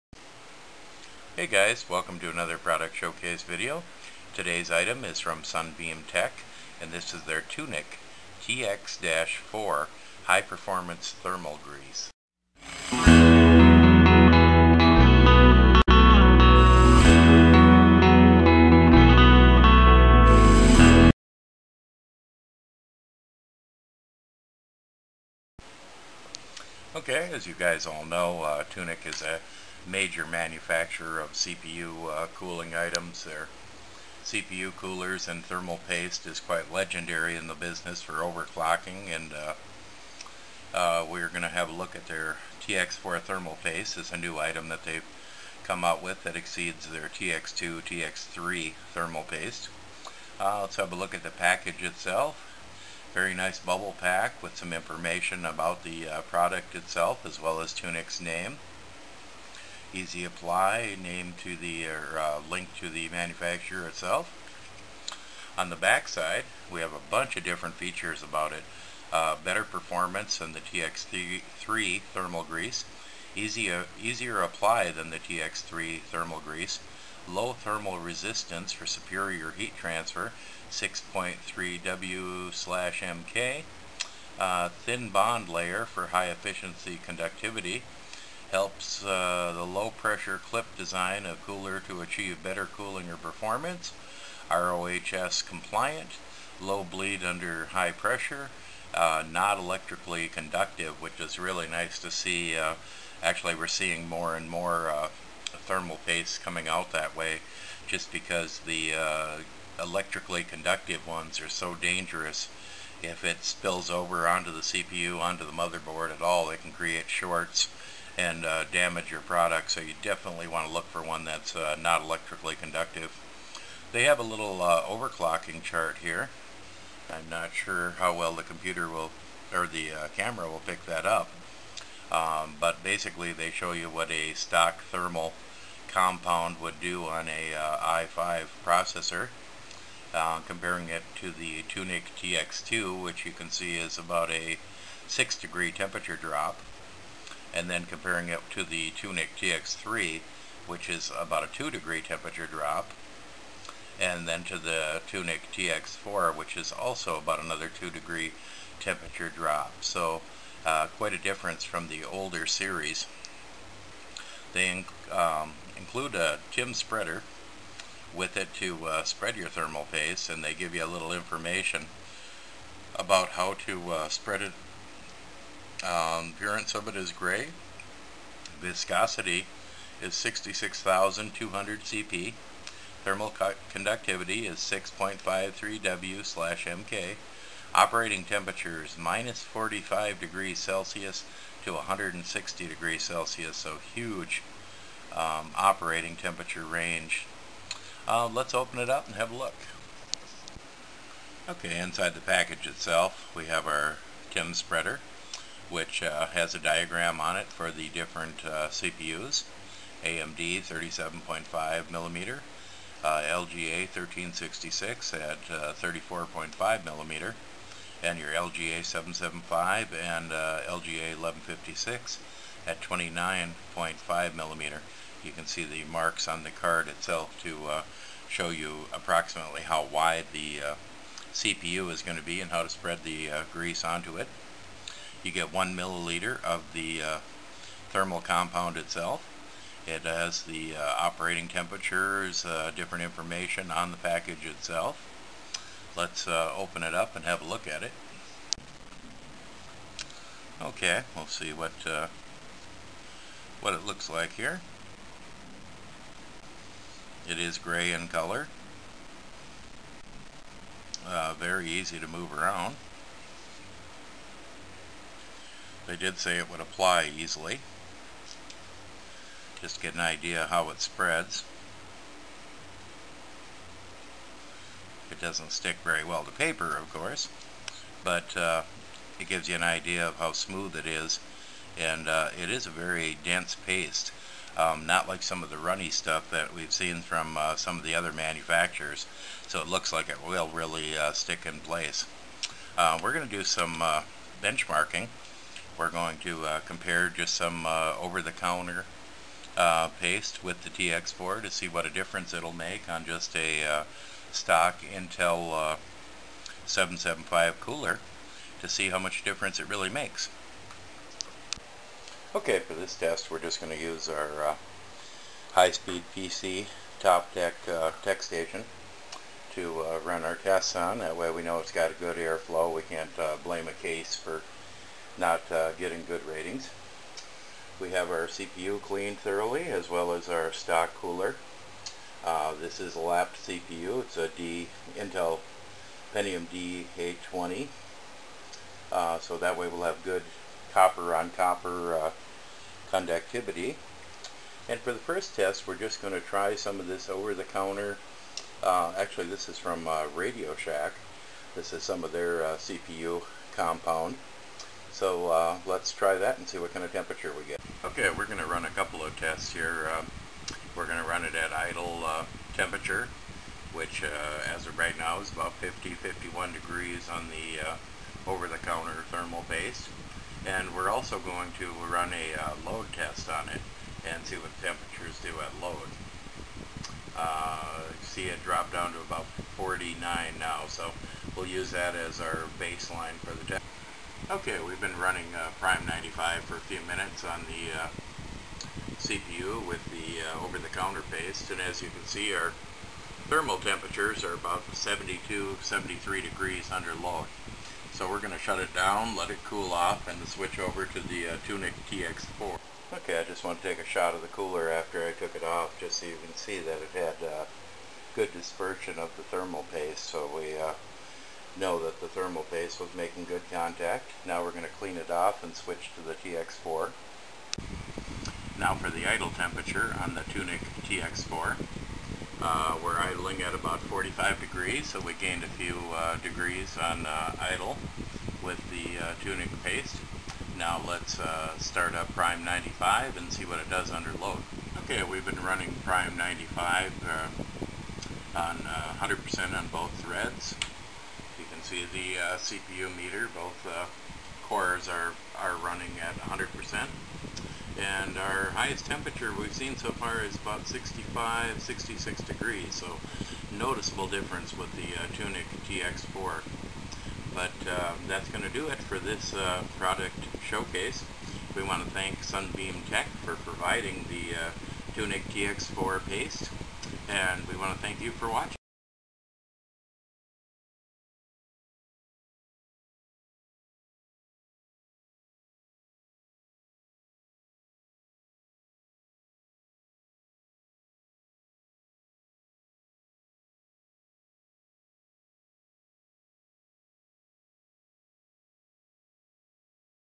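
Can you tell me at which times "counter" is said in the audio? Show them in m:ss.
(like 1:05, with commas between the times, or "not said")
4:57, 5:47, 6:08, 6:30.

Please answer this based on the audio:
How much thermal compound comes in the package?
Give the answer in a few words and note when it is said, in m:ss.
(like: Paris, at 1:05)
1 milliliter, at 3:55.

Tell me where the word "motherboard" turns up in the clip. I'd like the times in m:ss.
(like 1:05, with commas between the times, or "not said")
1:55.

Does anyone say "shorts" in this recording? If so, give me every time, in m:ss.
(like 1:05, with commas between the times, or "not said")
1:57.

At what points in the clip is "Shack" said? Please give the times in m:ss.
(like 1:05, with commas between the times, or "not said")
5:50.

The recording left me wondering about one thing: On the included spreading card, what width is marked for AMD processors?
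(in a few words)
37.5 millimeters.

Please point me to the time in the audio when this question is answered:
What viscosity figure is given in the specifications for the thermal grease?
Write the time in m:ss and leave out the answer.
3:00.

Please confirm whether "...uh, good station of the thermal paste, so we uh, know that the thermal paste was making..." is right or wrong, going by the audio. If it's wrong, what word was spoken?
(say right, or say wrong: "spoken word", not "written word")
wrong: "dispersion", not "station".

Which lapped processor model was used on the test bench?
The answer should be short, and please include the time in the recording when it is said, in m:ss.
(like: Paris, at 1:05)
Intel Pentium D820, at 5:34.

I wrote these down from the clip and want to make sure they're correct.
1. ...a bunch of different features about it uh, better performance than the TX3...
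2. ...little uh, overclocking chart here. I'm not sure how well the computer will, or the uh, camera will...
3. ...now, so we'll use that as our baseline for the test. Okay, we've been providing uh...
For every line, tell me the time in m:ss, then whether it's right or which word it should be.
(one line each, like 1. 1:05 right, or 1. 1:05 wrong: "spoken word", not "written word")
1. 1:06 right
2. 2:04 right
3. 6:20 wrong: "running", not "providing".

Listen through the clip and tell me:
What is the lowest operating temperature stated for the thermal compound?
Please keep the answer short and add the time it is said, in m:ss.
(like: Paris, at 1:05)
minus 45 degrees Celsius, at 3:08.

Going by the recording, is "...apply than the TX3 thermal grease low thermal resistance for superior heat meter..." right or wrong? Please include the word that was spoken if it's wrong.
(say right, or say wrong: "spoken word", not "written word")
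wrong: "transfer", not "meter".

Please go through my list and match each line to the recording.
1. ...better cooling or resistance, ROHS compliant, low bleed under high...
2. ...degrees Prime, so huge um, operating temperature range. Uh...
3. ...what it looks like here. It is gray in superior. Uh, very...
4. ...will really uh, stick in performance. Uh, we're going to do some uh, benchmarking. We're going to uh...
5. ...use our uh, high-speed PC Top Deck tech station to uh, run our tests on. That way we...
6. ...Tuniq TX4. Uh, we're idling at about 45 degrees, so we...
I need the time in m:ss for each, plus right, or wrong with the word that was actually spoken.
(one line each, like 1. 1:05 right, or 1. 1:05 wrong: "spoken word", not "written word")
1. 1:32 wrong: "performance", not "resistance"
2. 3:12 wrong: "Celsius", not "Prime"
3. 4:13 wrong: "color", not "superior"
4. 4:50 wrong: "place", not "performance"
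5. 5:13 right
6. 7:00 right.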